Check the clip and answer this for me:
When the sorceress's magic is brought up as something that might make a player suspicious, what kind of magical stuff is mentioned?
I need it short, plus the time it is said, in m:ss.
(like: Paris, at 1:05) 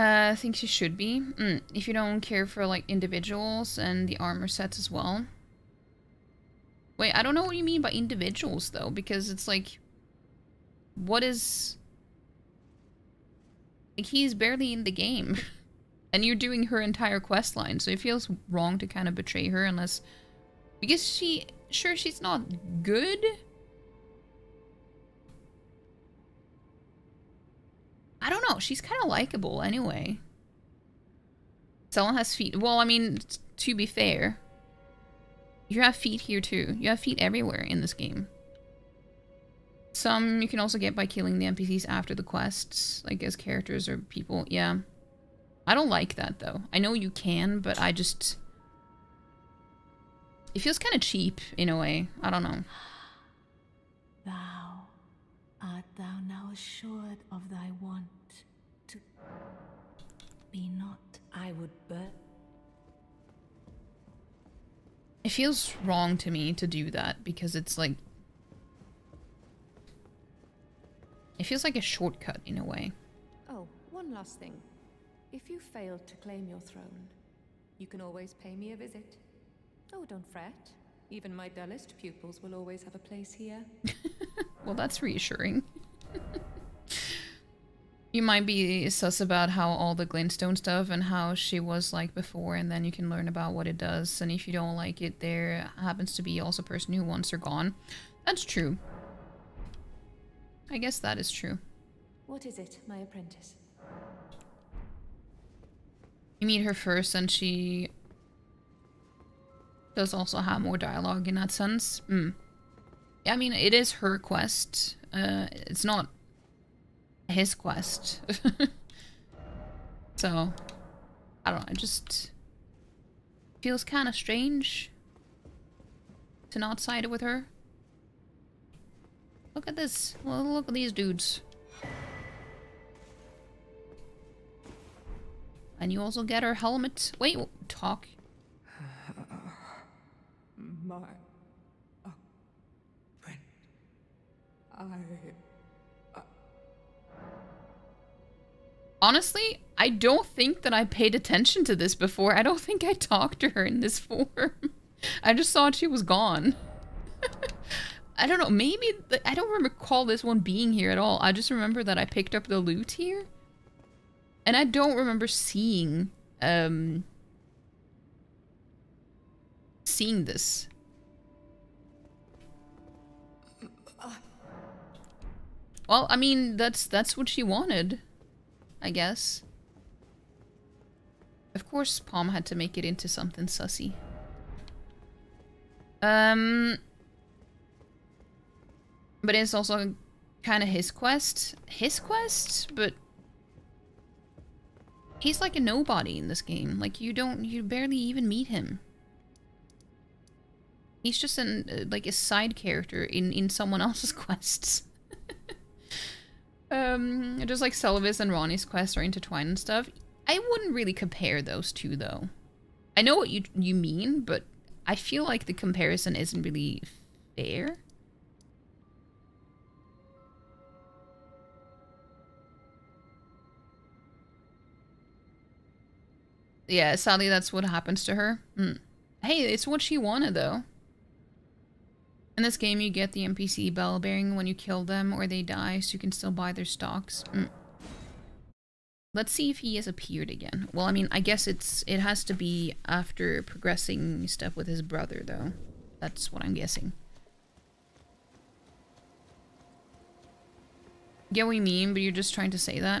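glintstone, at 1:30.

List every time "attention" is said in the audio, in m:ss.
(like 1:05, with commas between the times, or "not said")
2:31.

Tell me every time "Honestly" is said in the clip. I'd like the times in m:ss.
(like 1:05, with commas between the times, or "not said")
2:28.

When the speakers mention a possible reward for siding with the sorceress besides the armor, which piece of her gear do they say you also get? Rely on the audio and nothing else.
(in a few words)
her helmet.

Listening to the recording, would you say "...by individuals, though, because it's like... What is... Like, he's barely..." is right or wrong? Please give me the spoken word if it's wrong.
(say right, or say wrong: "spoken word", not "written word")
right.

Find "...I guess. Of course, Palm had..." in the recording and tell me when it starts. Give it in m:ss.
2:58.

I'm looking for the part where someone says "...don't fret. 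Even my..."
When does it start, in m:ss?
1:20.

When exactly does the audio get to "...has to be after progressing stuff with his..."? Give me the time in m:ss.
4:02.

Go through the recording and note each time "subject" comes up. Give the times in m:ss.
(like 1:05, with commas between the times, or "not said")
not said.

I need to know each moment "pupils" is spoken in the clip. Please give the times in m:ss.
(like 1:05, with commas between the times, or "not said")
1:21.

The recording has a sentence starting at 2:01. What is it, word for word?
It just feels kind of strange to not side with her.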